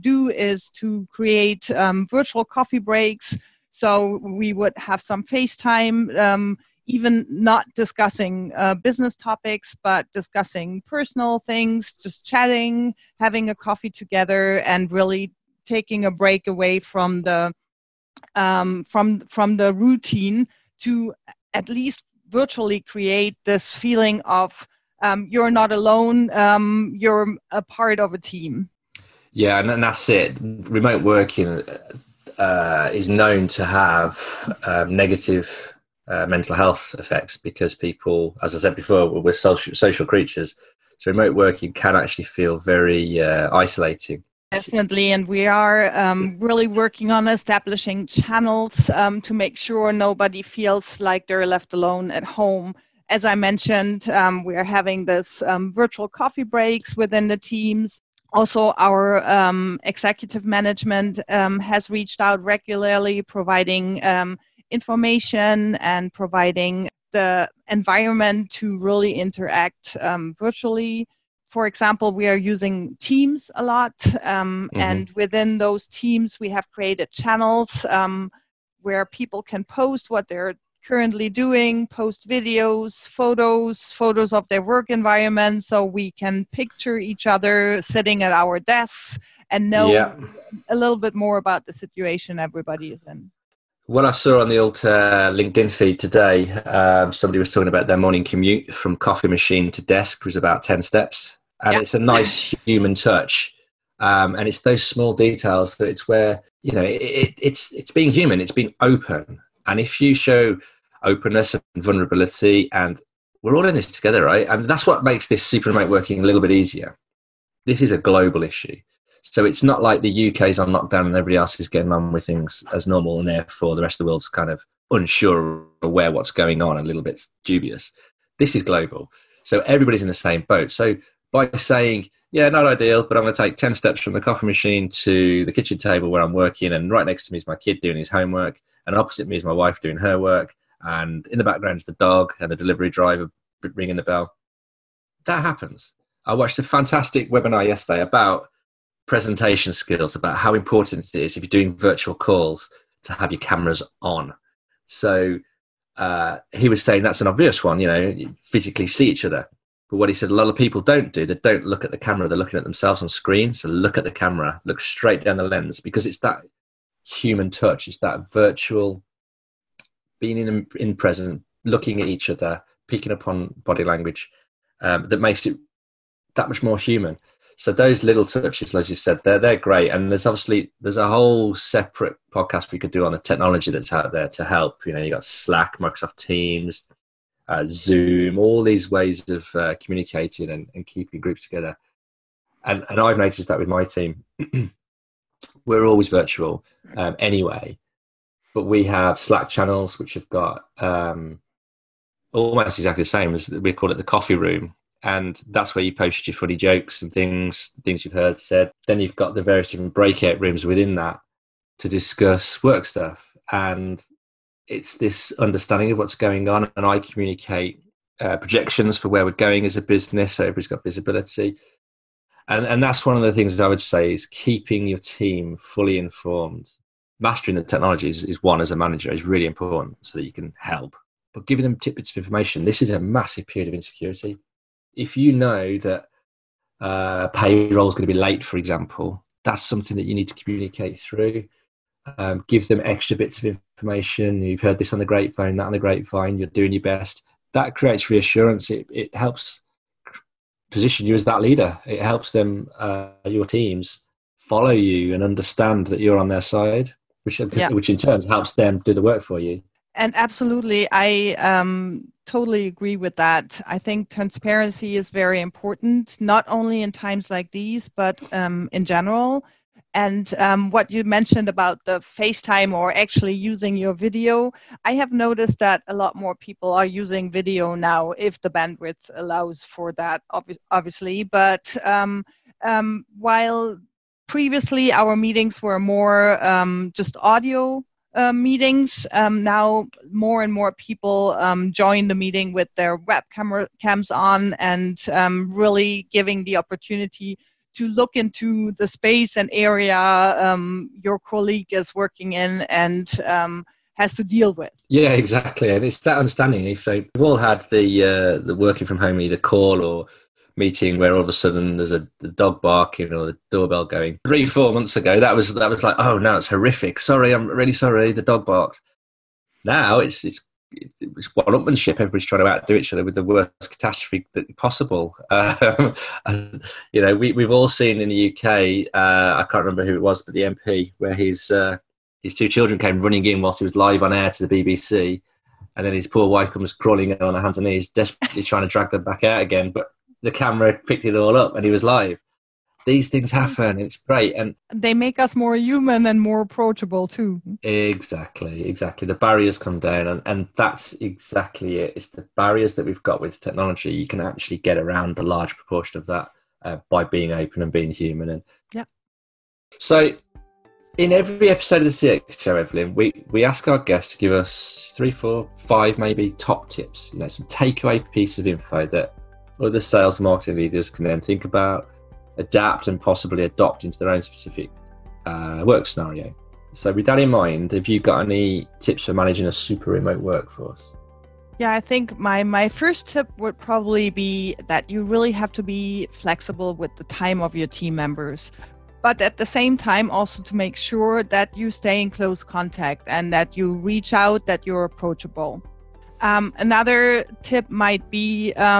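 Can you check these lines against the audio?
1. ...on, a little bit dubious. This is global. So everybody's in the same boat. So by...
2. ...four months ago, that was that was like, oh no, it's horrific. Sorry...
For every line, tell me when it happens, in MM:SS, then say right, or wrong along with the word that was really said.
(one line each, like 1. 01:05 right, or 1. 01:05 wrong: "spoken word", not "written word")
1. 02:06 right
2. 05:14 right.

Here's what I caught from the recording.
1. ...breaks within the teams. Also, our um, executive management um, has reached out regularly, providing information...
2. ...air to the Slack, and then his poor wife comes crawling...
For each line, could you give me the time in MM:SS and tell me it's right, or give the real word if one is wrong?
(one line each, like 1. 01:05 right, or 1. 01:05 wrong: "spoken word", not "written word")
1. 00:56 right
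2. 05:34 wrong: "BBC", not "Slack".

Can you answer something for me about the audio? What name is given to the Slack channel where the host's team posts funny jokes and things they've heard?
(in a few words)
the coffee room.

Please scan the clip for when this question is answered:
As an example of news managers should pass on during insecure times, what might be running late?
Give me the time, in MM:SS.
03:57.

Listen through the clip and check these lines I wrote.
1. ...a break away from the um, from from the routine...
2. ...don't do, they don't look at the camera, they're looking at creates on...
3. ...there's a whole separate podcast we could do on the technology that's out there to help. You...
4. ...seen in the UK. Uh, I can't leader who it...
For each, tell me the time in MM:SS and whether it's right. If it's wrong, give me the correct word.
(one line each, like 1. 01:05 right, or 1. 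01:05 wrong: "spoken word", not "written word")
1. 00:16 right
2. 02:40 wrong: "themselves", not "creates"
3. 03:00 right
4. 05:27 wrong: "remember", not "leader".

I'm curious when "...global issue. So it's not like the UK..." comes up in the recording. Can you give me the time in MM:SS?
01:57.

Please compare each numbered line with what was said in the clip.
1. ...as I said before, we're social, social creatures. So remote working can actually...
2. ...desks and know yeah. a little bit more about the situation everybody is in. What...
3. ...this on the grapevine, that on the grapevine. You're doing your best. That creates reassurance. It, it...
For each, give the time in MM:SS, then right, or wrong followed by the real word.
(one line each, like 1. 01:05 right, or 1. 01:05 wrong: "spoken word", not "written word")
1. 00:38 right
2. 01:28 right
3. 04:04 right.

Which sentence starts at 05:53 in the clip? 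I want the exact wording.
You can actually get around a large proportion of that uh, by being open and being human.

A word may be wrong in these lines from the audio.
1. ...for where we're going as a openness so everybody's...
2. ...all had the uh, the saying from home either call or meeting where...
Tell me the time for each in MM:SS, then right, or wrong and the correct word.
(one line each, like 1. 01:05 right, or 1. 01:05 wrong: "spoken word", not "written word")
1. 03:38 wrong: "business", not "openness"
2. 05:07 wrong: "working", not "saying".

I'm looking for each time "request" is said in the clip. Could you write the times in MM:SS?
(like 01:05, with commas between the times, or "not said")
not said.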